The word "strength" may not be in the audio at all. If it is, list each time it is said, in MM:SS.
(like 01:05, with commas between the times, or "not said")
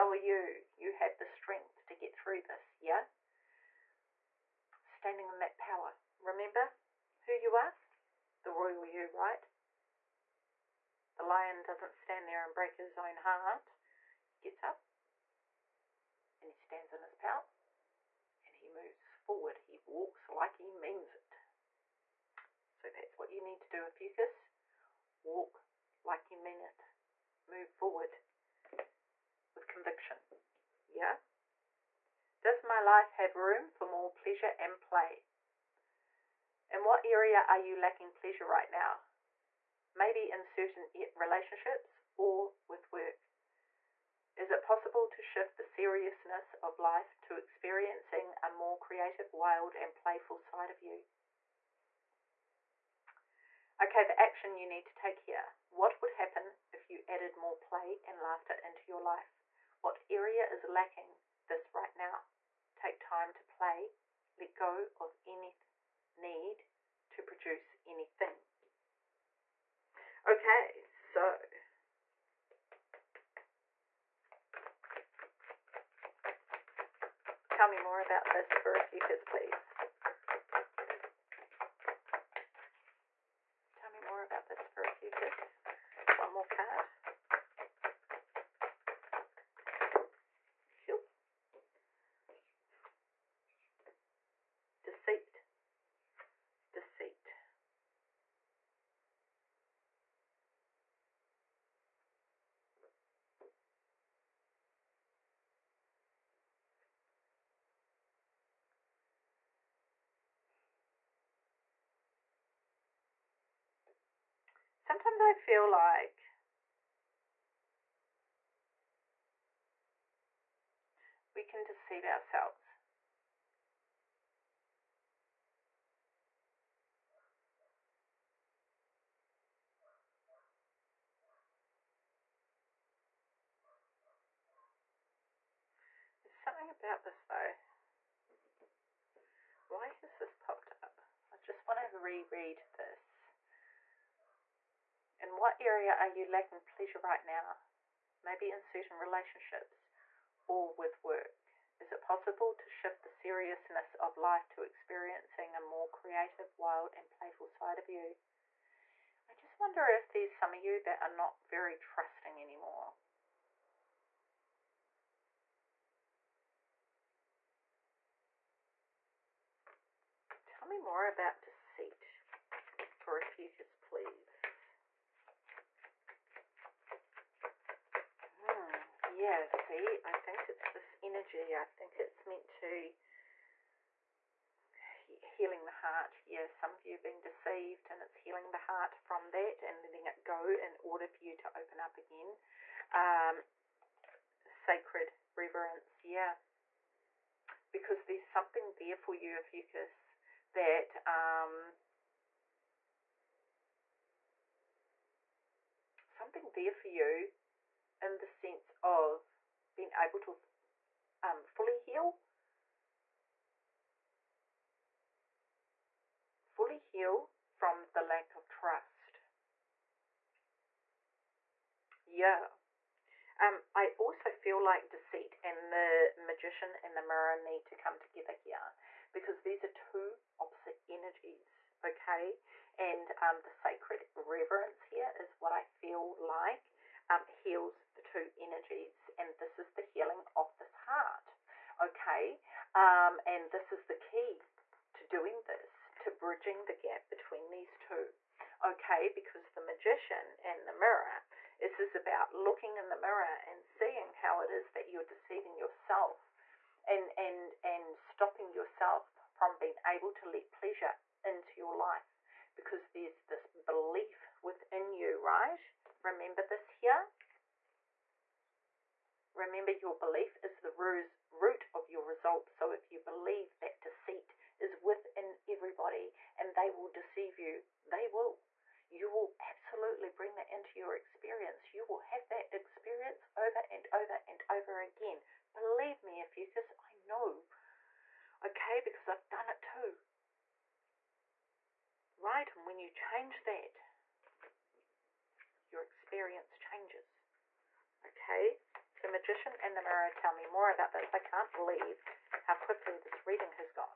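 00:01.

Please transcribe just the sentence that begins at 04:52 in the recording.
And when you change that, your experience changes.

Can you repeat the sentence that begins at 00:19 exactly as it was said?
He walks like he means it.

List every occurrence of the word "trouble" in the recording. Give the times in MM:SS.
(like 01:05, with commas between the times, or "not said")
not said.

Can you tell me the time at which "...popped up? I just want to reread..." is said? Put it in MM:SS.
02:20.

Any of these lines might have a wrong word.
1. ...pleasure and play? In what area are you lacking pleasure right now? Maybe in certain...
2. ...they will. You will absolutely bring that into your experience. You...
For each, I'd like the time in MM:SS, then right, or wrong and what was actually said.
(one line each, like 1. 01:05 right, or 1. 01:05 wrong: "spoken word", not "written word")
1. 00:34 right
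2. 04:37 right.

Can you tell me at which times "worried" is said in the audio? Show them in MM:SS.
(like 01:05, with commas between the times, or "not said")
not said.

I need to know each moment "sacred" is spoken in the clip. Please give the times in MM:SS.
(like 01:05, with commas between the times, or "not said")
03:14, 03:53.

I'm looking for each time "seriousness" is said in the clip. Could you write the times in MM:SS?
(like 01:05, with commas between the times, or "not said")
00:45, 02:33.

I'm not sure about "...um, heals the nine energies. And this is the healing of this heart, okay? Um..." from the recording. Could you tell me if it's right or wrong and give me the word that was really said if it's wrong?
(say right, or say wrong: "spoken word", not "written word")
wrong: "two", not "nine".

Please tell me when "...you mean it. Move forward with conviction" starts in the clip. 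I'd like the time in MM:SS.
00:26.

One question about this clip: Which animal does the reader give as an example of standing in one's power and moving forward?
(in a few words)
The lion.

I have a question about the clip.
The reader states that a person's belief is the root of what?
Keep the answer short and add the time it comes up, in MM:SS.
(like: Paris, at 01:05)
Your result, at 04:31.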